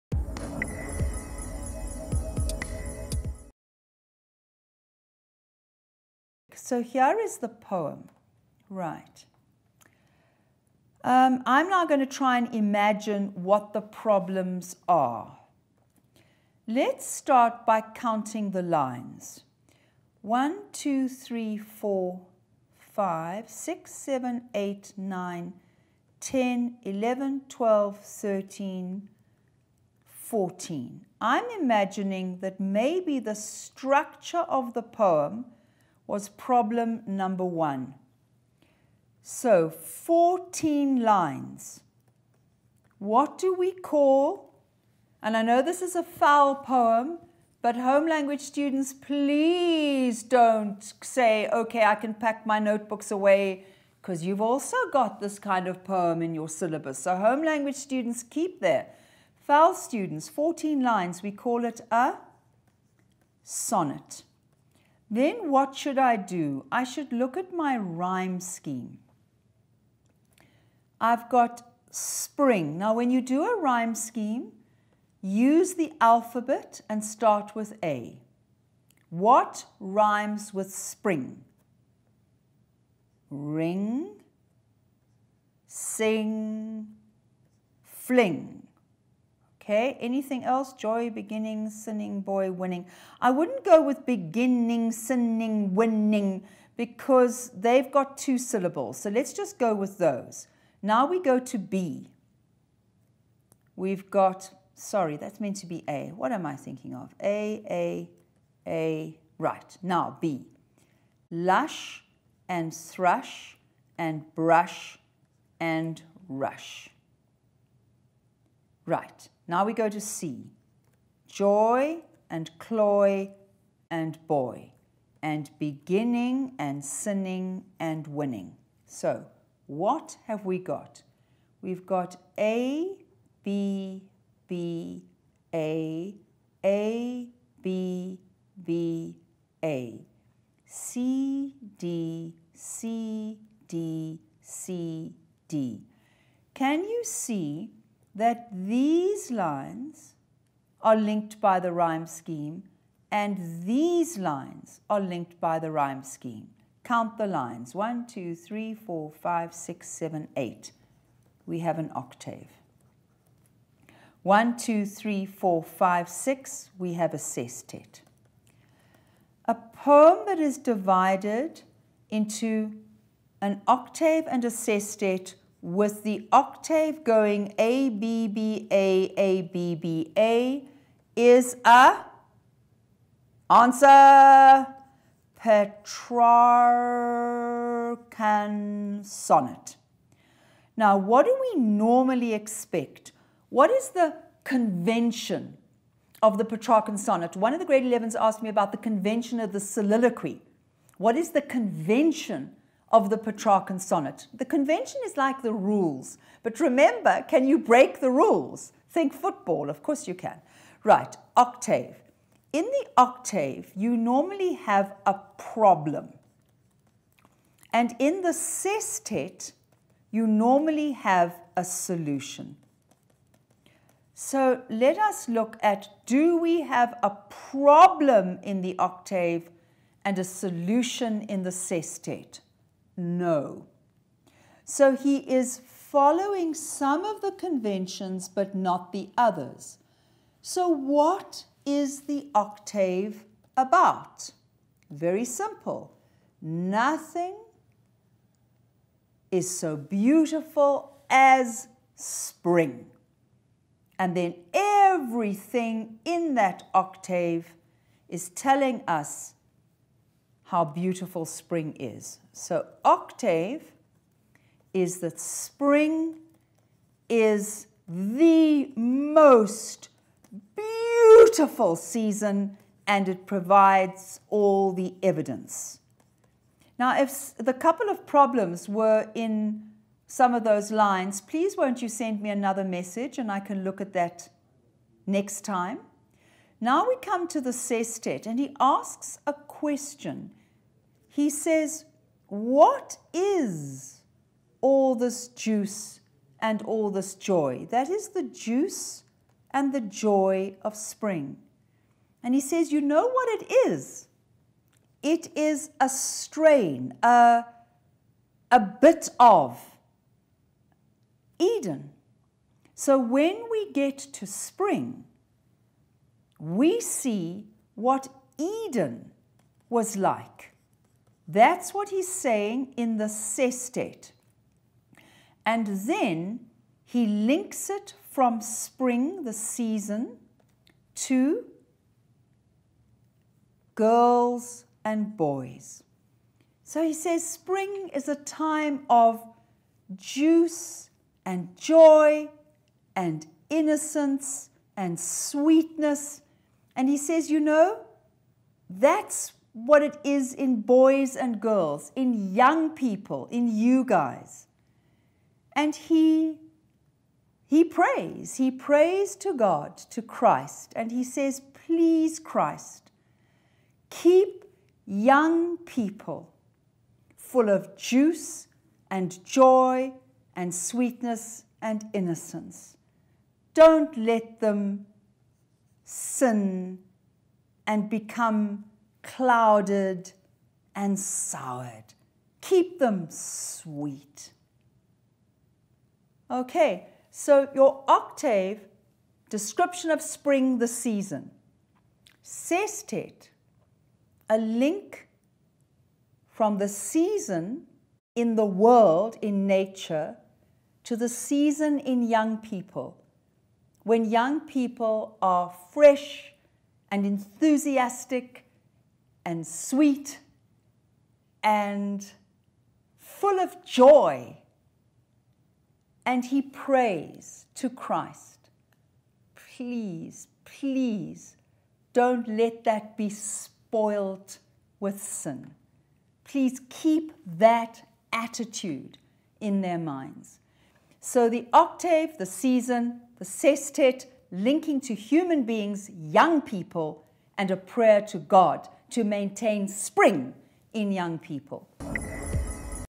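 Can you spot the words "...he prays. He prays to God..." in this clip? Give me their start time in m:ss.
5:57.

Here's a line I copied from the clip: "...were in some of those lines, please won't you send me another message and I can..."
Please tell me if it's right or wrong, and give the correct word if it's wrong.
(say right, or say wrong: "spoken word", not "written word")
right.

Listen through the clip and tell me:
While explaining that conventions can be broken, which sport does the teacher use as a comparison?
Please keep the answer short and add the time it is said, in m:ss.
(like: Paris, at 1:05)
football, at 3:29.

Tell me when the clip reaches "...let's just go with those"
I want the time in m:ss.
1:39.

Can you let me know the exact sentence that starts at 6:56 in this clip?
And he prays to Christ, please, please don't let that be spoilt with sin.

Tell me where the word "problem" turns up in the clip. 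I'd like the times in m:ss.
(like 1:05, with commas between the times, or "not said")
0:13, 0:36, 3:35, 3:47, 4:38.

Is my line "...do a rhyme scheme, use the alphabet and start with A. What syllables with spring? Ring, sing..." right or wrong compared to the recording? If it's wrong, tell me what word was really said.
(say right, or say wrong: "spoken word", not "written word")
wrong: "rhymes", not "syllables".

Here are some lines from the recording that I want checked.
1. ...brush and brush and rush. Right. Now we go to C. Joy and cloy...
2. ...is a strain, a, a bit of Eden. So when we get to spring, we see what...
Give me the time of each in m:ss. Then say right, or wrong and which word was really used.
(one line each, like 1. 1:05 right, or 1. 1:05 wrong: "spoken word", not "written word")
1. 1:52 wrong: "thrush", not "brush"
2. 5:05 right.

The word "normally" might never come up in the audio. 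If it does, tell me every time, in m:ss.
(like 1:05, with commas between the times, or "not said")
3:11, 3:33, 3:40.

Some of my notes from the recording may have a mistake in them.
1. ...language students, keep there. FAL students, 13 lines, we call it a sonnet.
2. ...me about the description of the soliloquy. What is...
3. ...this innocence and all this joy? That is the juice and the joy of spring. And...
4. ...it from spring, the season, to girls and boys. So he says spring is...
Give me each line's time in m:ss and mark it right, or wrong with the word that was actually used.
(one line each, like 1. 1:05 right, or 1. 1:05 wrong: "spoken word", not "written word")
1. 0:57 wrong: "14", not "13"
2. 3:18 wrong: "convention", not "description"
3. 4:54 wrong: "juice", not "innocence"
4. 5:27 right.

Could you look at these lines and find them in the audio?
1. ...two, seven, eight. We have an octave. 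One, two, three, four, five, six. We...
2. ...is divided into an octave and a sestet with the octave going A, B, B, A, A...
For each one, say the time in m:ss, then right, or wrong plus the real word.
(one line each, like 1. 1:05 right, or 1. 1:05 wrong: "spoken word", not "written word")
1. 2:39 wrong: "six", not "two"
2. 2:50 right.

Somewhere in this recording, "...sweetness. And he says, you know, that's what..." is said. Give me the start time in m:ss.
5:44.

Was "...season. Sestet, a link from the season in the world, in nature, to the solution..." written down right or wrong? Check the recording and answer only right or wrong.
wrong.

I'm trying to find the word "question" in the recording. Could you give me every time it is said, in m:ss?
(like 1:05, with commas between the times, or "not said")
4:49.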